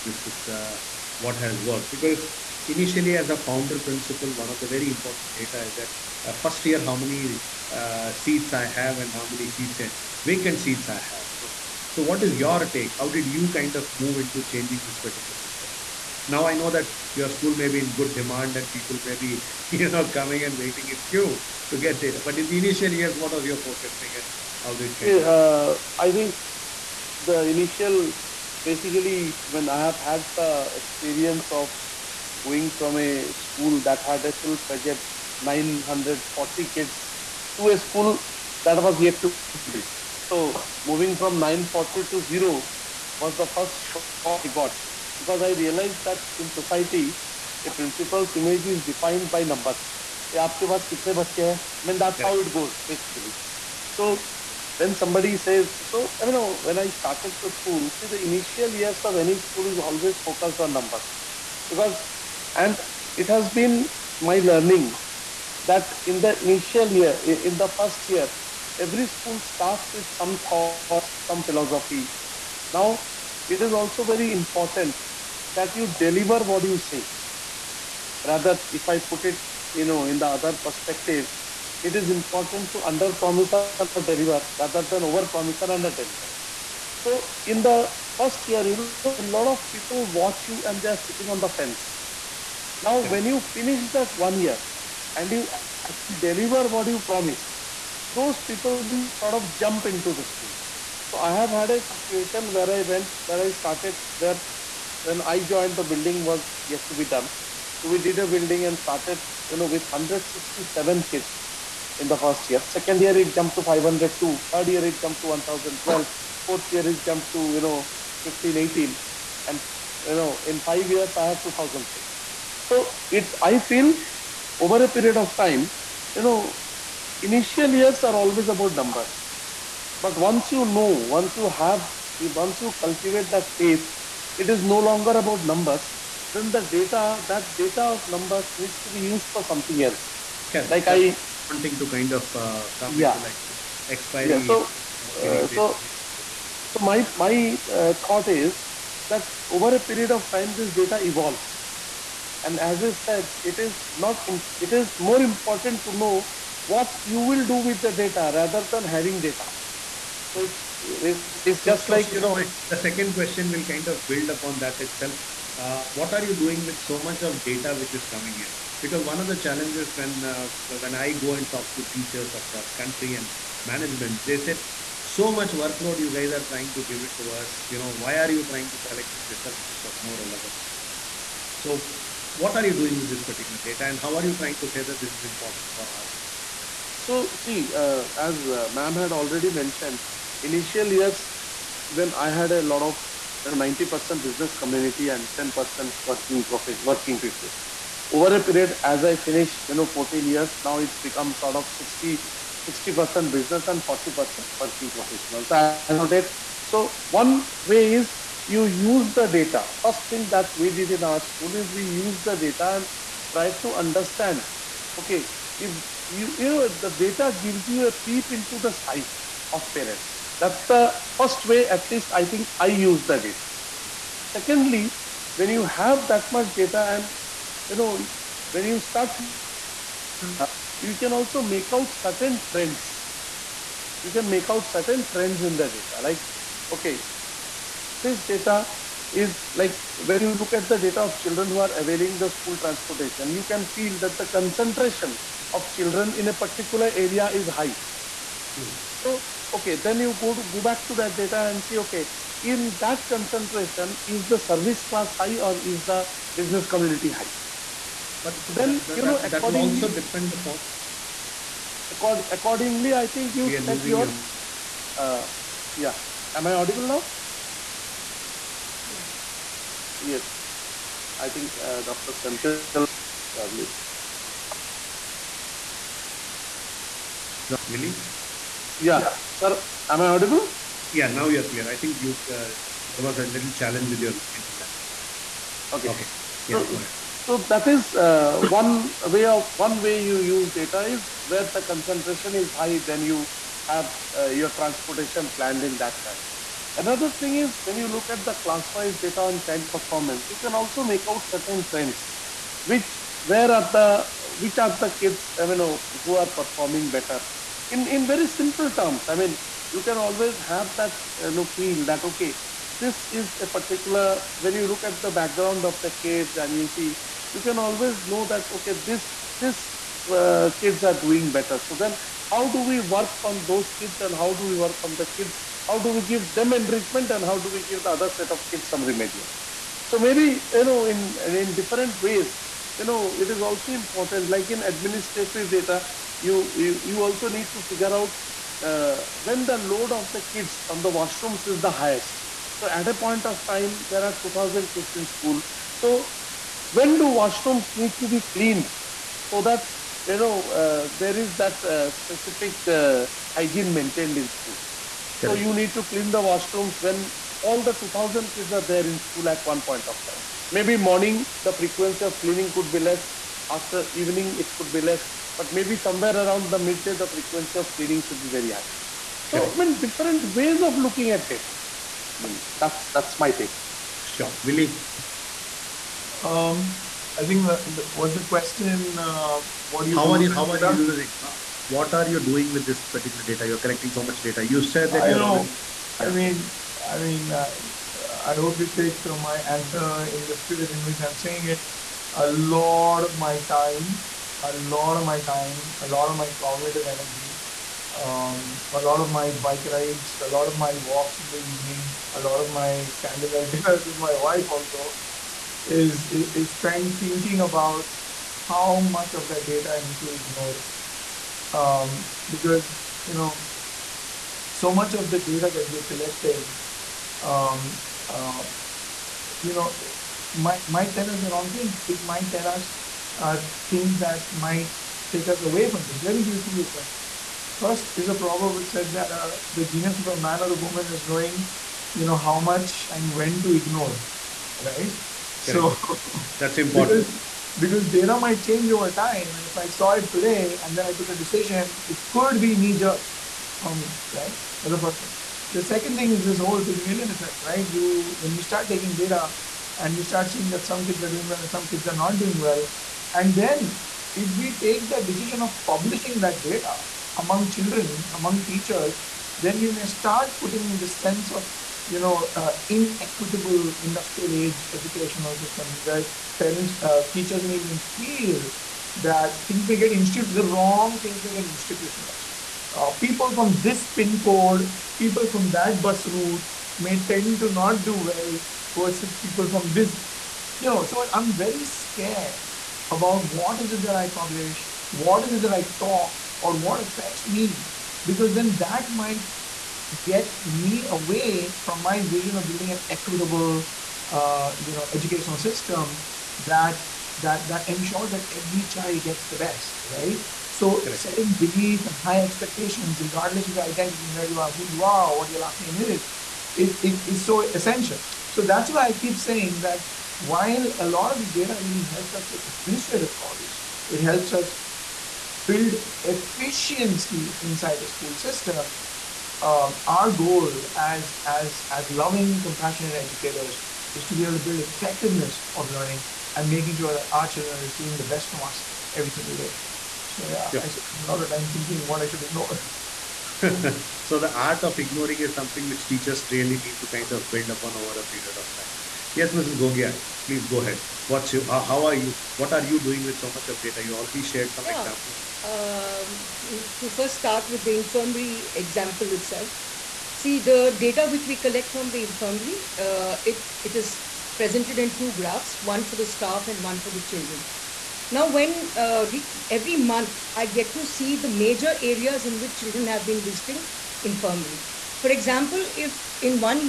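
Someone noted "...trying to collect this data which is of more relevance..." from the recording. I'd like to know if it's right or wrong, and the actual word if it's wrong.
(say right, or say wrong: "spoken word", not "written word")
right.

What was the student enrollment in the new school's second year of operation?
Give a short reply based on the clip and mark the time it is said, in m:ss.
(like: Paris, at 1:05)
502, at 1:53.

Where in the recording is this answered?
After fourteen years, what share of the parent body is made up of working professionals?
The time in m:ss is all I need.
3:23.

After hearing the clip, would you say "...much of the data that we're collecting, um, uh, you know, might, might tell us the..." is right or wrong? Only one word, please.
right.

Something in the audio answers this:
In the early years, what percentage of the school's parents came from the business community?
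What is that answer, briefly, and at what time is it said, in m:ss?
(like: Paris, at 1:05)
90%, at 3:13.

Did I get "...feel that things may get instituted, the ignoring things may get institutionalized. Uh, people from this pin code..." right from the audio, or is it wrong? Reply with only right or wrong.
wrong.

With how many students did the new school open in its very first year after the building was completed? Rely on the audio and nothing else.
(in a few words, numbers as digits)
167.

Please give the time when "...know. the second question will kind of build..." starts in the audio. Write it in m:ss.
2:42.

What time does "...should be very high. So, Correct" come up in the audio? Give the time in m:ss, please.
6:08.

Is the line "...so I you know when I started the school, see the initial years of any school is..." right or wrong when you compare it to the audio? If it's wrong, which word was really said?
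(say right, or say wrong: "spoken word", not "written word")
right.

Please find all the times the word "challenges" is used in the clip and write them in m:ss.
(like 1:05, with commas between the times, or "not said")
2:49, 4:43.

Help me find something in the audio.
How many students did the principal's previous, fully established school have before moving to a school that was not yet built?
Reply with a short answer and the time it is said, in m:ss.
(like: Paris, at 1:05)
940, at 0:35.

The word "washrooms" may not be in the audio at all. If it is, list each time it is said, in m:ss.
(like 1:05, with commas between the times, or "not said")
5:40, 5:47, 5:56.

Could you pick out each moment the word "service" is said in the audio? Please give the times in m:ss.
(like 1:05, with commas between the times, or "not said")
4:14.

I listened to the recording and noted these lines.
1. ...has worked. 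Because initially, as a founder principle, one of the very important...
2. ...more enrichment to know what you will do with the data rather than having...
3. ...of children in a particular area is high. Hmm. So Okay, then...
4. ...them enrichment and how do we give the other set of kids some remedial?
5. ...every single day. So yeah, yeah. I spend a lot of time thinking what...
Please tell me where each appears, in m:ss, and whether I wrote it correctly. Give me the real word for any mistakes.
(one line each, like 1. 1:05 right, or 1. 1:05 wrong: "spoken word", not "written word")
1. 0:01 right
2. 2:34 wrong: "important", not "enrichment"
3. 4:05 right
4. 5:26 right
5. 8:48 right.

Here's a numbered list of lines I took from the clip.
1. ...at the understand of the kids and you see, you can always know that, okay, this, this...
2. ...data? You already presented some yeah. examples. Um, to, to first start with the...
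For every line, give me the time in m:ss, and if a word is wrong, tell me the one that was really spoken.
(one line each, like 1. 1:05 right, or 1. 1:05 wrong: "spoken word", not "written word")
1. 5:14 wrong: "background", not "understand"
2. 9:03 wrong: "shared", not "presented".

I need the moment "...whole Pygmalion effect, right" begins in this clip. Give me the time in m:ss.
7:26.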